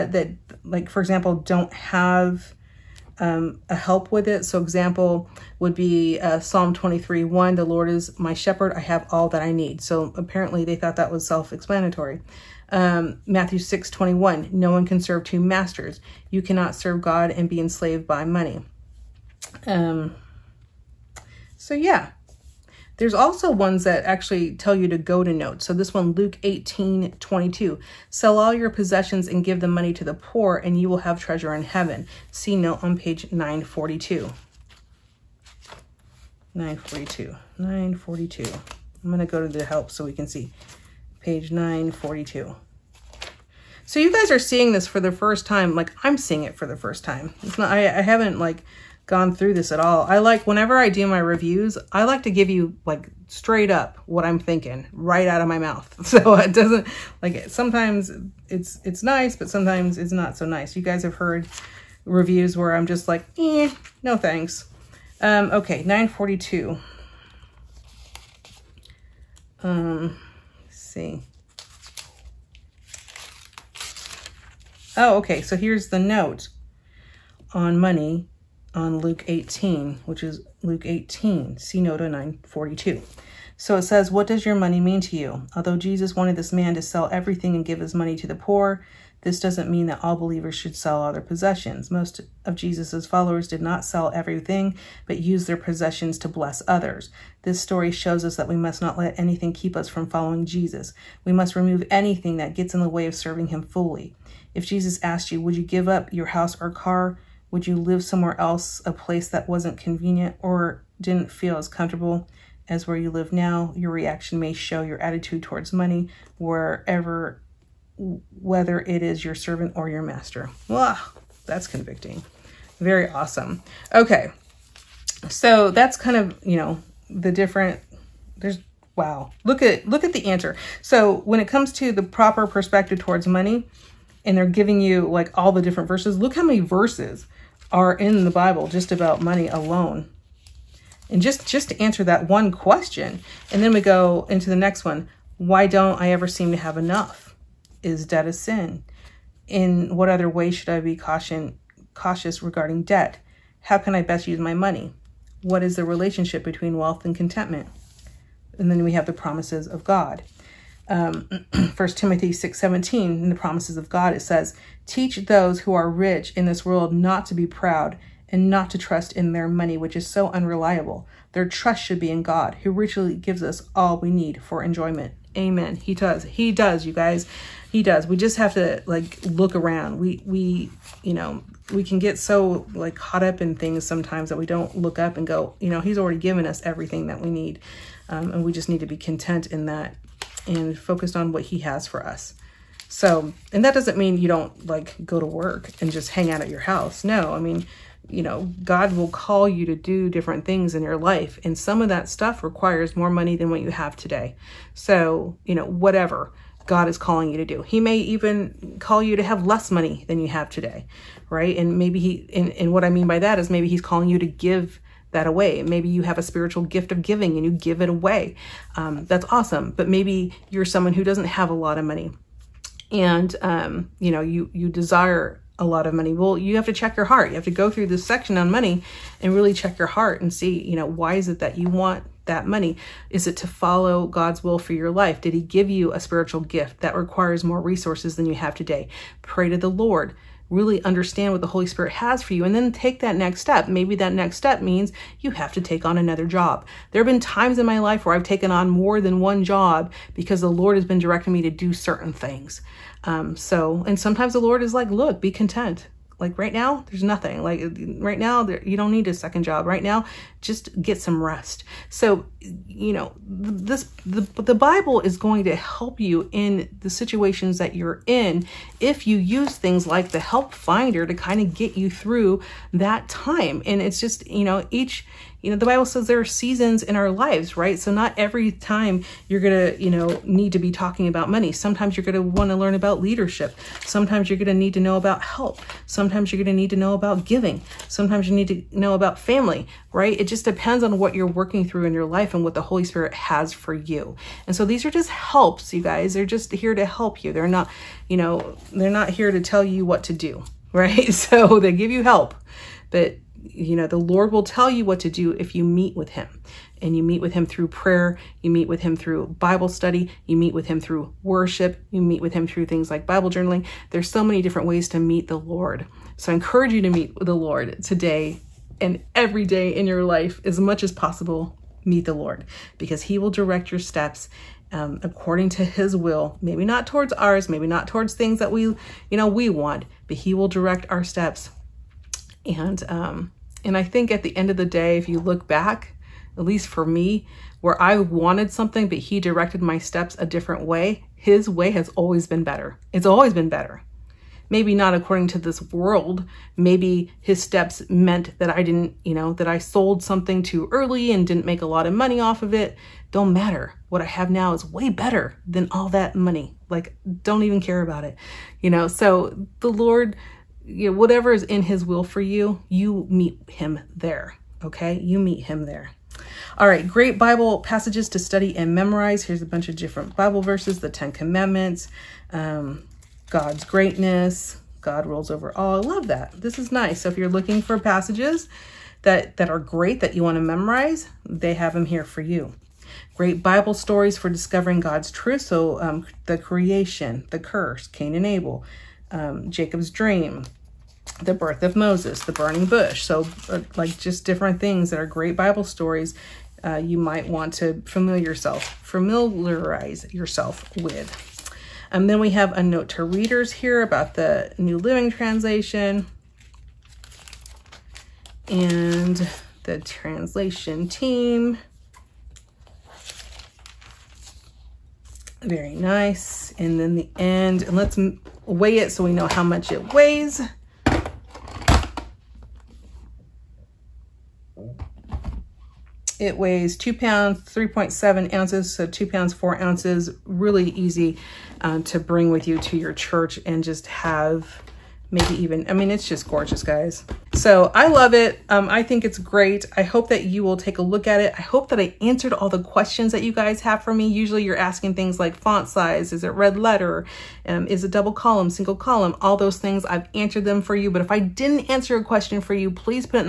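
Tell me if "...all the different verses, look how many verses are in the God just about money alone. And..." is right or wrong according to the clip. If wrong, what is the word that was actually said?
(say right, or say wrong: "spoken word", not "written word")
wrong: "Bible", not "God".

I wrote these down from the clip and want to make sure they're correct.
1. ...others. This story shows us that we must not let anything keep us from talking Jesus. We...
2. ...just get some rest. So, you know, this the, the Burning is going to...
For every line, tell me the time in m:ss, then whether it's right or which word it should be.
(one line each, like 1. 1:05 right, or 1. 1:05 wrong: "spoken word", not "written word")
1. 1:36 wrong: "following", not "talking"
2. 4:20 wrong: "Bible", not "Burning".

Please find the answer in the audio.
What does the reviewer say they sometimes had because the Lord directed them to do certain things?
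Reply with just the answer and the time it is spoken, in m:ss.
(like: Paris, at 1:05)
More than one job, at 4:08.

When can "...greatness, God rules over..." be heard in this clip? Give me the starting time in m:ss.
6:13.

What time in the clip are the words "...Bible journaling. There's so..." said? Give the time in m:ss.
5:13.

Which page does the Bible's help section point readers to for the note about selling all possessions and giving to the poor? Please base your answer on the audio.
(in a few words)
942.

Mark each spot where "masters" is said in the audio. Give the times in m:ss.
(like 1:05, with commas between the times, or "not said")
0:15, 2:00.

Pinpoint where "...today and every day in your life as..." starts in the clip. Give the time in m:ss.
5:17.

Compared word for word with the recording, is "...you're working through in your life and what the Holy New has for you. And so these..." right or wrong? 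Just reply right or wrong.
wrong.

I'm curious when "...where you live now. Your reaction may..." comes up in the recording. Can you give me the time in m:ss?
1:52.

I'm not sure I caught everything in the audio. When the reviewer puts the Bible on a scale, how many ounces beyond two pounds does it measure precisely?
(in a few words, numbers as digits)
3.7.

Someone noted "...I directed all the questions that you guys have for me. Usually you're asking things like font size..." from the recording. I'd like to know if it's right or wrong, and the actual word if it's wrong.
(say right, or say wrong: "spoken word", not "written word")
wrong: "answered", not "directed".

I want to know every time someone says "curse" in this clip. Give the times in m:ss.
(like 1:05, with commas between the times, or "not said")
6:27.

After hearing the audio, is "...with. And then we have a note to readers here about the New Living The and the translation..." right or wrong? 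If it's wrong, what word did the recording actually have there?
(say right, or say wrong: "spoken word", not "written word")
wrong: "Translation", not "The".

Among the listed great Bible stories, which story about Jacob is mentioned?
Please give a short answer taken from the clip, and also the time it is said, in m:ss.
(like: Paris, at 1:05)
Jacob's Dream, at 6:29.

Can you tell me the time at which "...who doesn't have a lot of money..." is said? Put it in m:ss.
3:40.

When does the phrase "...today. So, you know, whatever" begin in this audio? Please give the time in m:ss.
3:23.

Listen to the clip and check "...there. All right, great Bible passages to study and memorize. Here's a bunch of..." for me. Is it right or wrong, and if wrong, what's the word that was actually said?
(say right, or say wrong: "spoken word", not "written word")
right.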